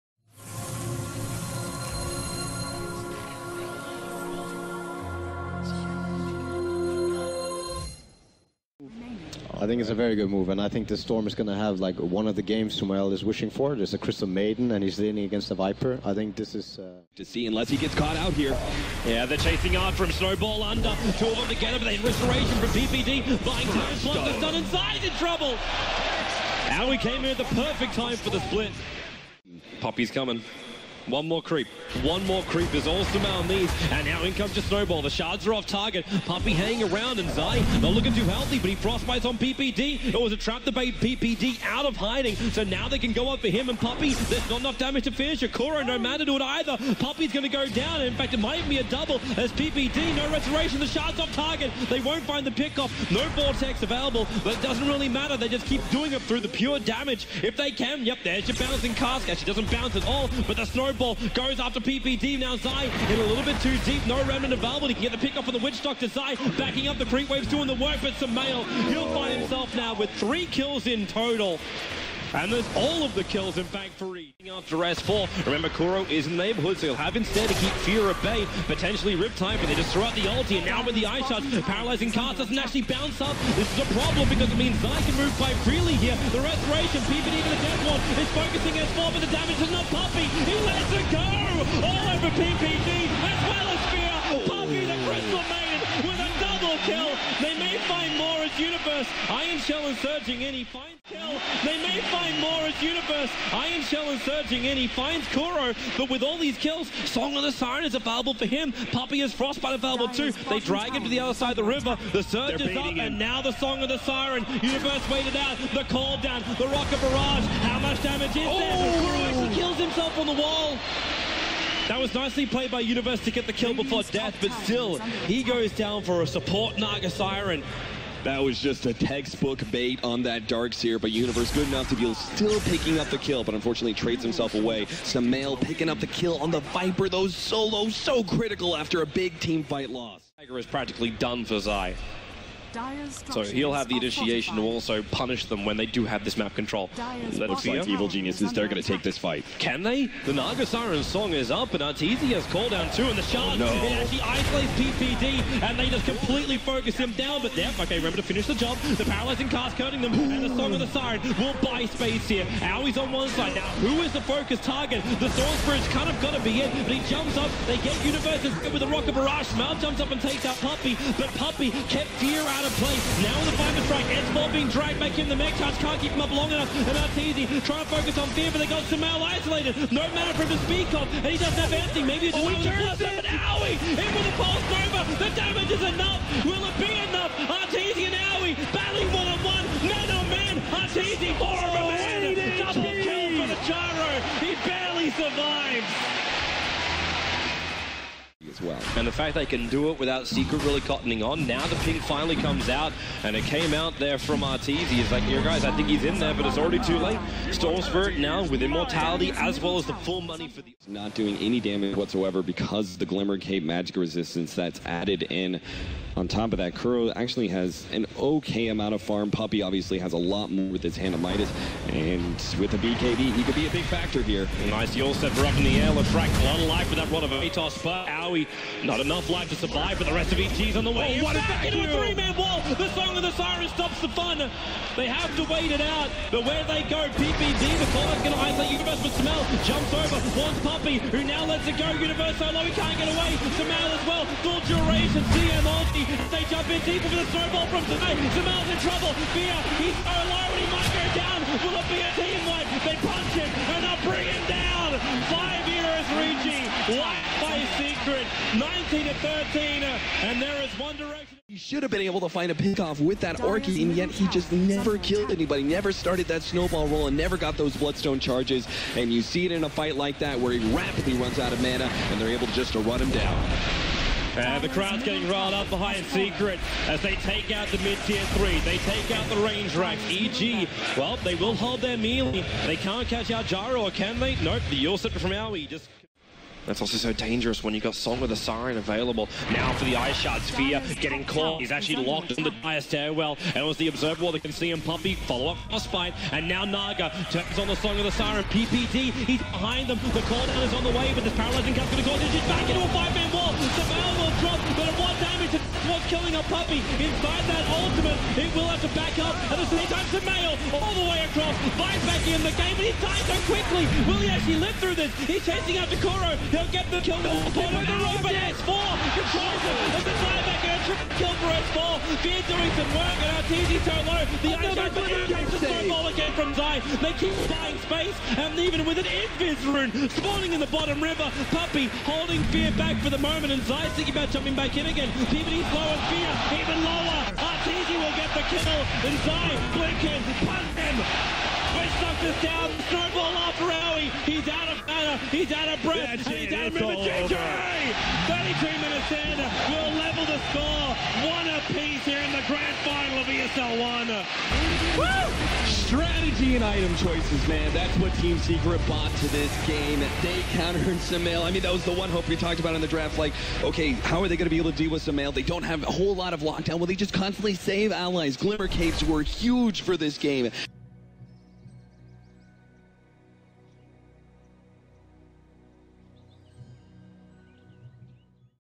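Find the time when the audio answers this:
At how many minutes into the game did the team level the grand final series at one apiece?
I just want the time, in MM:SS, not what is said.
05:48.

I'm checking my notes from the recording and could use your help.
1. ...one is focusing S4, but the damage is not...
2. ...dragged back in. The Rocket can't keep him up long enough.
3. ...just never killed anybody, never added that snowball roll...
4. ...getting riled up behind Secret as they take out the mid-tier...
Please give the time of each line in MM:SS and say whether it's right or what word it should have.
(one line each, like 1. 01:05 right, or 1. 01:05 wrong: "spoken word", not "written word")
1. 01:27 right
2. 02:54 wrong: "Magpies", not "Rocket"
3. 04:24 wrong: "started", not "added"
4. 04:35 right.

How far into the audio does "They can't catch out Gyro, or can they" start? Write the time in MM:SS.
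04:42.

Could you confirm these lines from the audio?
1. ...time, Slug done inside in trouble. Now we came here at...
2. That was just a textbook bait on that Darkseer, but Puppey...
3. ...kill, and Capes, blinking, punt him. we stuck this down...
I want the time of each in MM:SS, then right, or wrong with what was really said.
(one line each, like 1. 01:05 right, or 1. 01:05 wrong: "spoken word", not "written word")
1. 00:23 right
2. 02:08 wrong: "Universe", not "Puppey"
3. 05:38 wrong: "Zai", not "Capes".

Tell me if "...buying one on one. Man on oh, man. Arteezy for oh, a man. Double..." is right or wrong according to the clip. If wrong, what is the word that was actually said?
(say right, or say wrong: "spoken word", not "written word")
wrong: "battling", not "buying".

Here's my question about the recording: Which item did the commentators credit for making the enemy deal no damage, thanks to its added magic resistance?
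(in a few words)
Glimmer Cape.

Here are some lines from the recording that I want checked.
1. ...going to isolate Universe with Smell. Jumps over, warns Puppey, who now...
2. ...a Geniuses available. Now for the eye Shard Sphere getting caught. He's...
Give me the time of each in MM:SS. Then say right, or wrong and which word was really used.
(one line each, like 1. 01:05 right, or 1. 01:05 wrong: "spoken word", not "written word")
1. 03:58 right
2. 04:48 wrong: "Siren", not "Geniuses".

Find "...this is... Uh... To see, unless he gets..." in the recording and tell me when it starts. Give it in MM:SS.
00:16.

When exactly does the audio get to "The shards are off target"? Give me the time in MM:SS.
00:35.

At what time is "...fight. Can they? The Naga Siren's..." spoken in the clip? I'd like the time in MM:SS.
02:29.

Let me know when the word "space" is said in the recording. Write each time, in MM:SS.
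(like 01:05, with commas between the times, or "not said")
02:41, 05:27.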